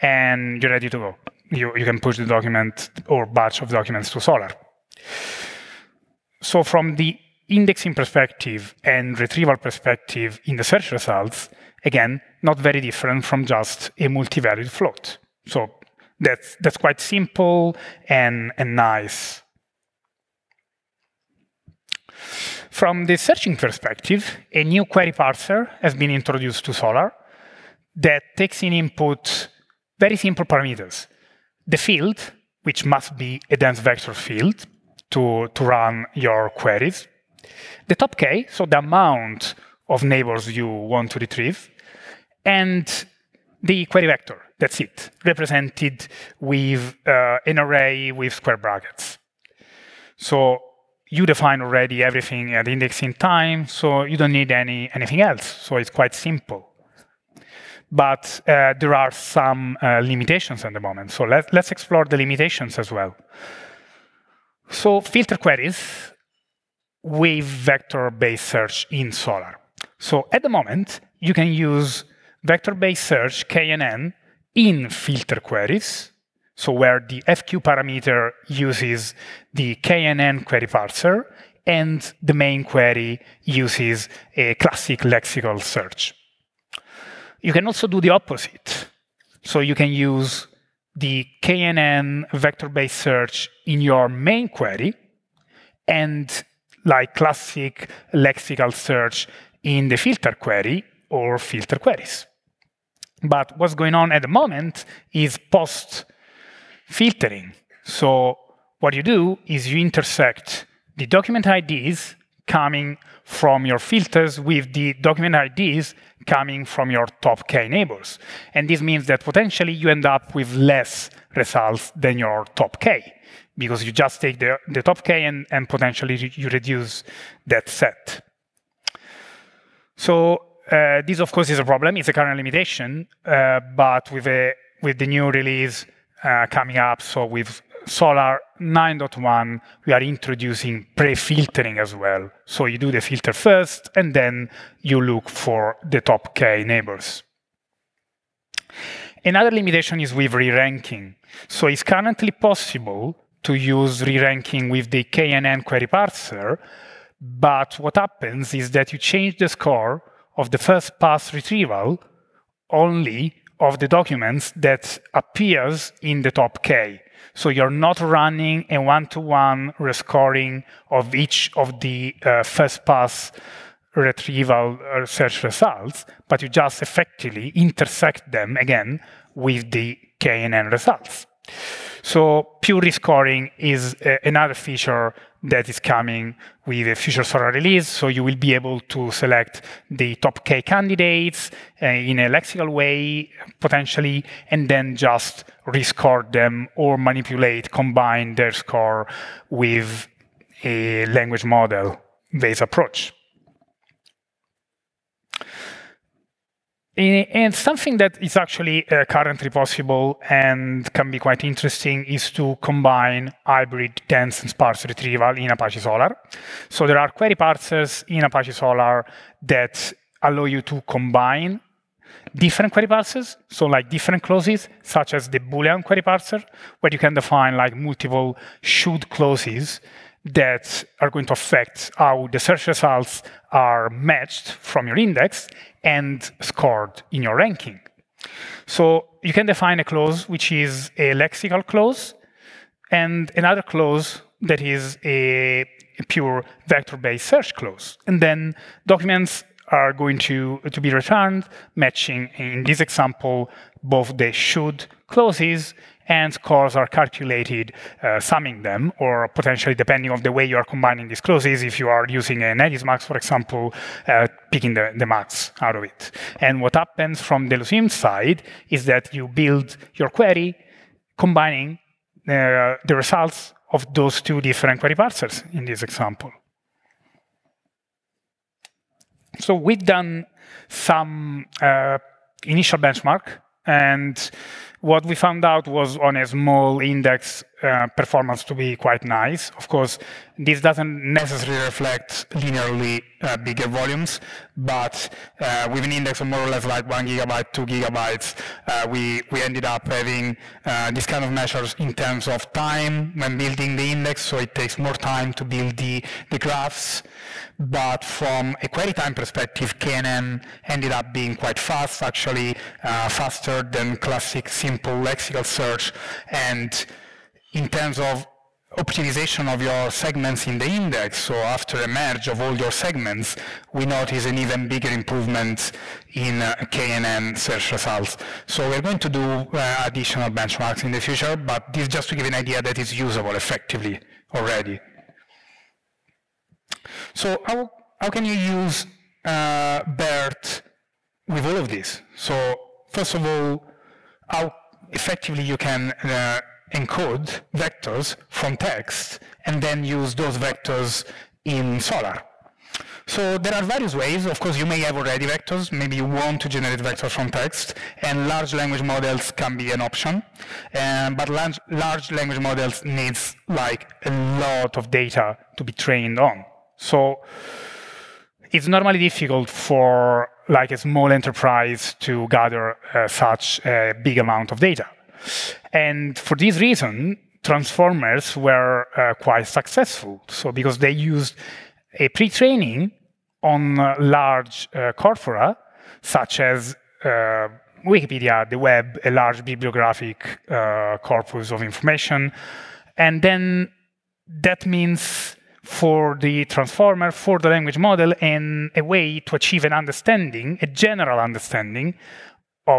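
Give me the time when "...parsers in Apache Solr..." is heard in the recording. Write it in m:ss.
3:37.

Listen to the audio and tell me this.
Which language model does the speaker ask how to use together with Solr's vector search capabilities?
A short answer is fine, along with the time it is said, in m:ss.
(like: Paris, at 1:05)
BERT, at 5:39.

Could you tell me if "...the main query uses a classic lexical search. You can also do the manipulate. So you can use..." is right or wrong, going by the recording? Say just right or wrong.
wrong.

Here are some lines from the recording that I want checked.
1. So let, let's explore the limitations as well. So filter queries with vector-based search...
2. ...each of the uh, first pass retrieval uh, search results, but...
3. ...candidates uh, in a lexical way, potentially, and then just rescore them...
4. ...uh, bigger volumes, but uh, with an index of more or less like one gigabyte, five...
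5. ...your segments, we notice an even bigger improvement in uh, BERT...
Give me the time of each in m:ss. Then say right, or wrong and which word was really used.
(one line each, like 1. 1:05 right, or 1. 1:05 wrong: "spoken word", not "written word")
1. 1:01 right
2. 2:51 right
3. 3:10 right
4. 4:53 wrong: "two", not "five"
5. 5:22 wrong: "KNN", not "BERT".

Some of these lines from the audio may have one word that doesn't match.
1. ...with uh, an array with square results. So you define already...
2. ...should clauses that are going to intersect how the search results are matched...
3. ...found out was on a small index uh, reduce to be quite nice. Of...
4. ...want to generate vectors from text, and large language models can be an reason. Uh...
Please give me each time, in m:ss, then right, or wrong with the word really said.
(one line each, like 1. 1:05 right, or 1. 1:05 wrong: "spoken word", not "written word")
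1. 0:46 wrong: "brackets", not "results"
2. 3:48 wrong: "affect", not "intersect"
3. 4:45 wrong: "performance", not "reduce"
4. 5:56 wrong: "option", not "reason".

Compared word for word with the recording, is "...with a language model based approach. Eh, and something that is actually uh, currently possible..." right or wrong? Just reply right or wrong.
right.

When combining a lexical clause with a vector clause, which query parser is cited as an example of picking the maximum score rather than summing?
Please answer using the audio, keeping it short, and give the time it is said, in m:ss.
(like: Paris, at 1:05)
edismax, at 4:22.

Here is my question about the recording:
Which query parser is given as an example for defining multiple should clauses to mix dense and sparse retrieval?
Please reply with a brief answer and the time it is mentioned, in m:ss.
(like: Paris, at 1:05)
Boolean query parser, at 3:45.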